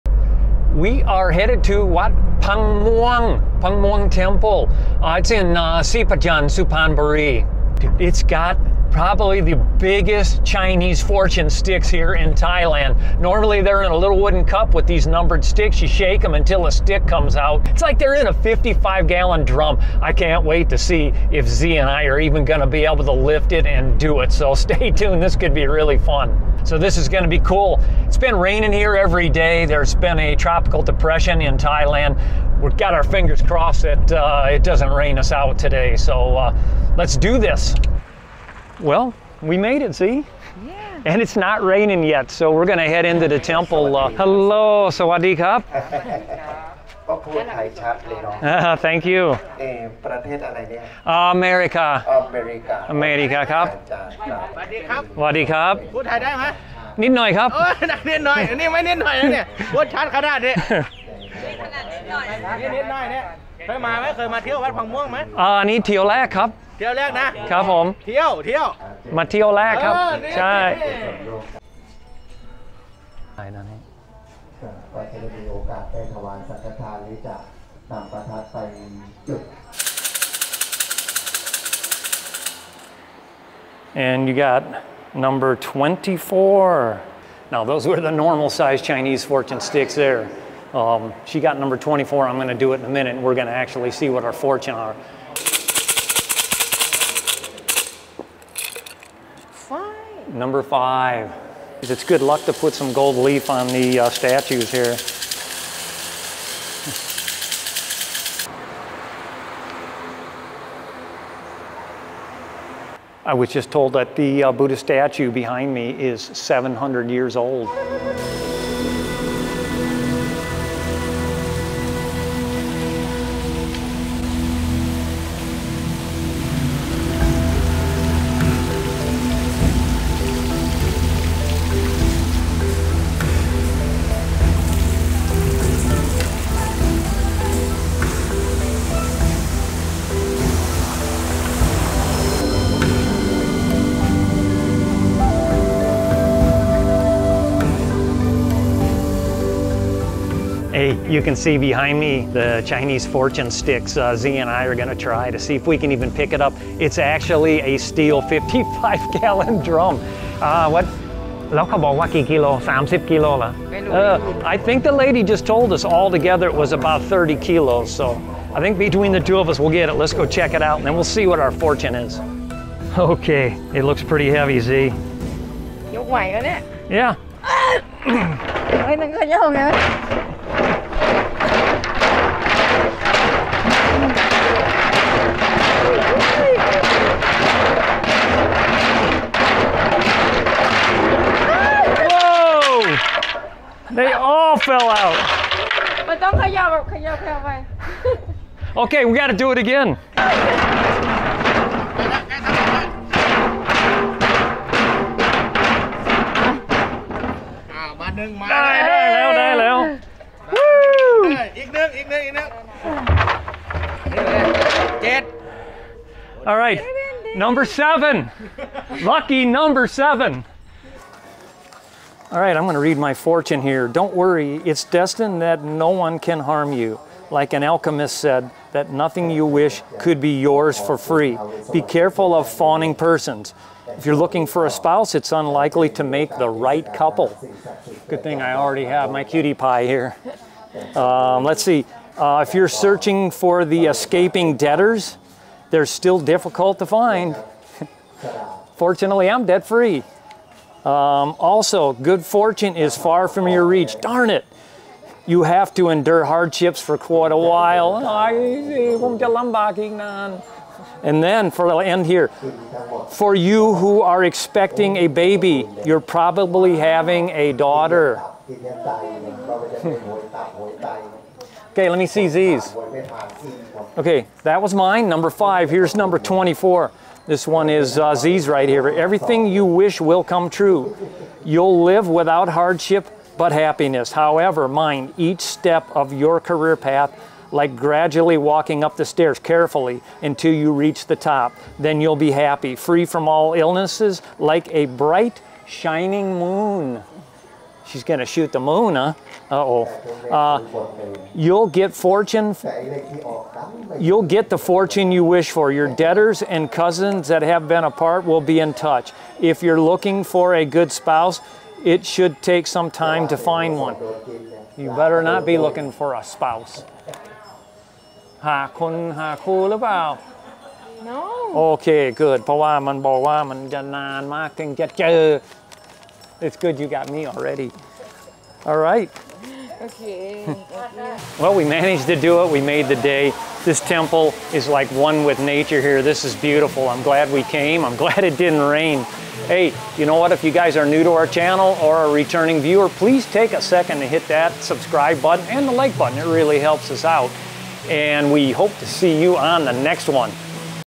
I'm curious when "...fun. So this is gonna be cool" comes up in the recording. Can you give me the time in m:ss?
0:25.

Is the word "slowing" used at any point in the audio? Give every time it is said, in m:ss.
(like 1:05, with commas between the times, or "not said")
not said.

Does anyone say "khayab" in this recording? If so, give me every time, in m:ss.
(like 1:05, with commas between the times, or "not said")
3:16.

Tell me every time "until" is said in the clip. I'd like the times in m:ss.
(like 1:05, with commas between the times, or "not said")
0:16, 4:50.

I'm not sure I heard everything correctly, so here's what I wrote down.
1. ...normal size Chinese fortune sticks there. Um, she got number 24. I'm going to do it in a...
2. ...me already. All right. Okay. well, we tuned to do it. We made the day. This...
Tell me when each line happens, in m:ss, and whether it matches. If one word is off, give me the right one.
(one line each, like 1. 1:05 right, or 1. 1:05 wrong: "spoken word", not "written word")
1. 1:28 right
2. 5:27 wrong: "managed", not "tuned".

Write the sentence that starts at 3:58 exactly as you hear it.
Good thing I already have my cutie pie here.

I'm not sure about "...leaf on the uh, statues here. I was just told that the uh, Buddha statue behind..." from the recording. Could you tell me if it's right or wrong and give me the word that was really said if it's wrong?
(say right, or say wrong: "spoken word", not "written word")
right.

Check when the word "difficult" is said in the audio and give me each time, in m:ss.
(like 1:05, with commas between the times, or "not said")
4:06.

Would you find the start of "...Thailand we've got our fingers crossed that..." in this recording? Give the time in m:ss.
0:31.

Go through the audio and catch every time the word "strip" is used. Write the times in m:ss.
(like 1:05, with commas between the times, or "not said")
not said.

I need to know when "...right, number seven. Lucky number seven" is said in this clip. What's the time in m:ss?
3:36.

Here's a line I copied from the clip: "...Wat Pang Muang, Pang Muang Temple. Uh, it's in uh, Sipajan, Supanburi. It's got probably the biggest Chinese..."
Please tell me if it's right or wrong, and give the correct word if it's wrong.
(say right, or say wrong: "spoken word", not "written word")
right.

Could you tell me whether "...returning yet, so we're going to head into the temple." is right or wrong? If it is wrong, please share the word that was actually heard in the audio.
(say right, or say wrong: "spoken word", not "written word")
wrong: "raining", not "returning".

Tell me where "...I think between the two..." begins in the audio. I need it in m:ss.
2:48.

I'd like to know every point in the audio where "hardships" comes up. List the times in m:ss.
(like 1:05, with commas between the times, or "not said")
4:16, 4:42.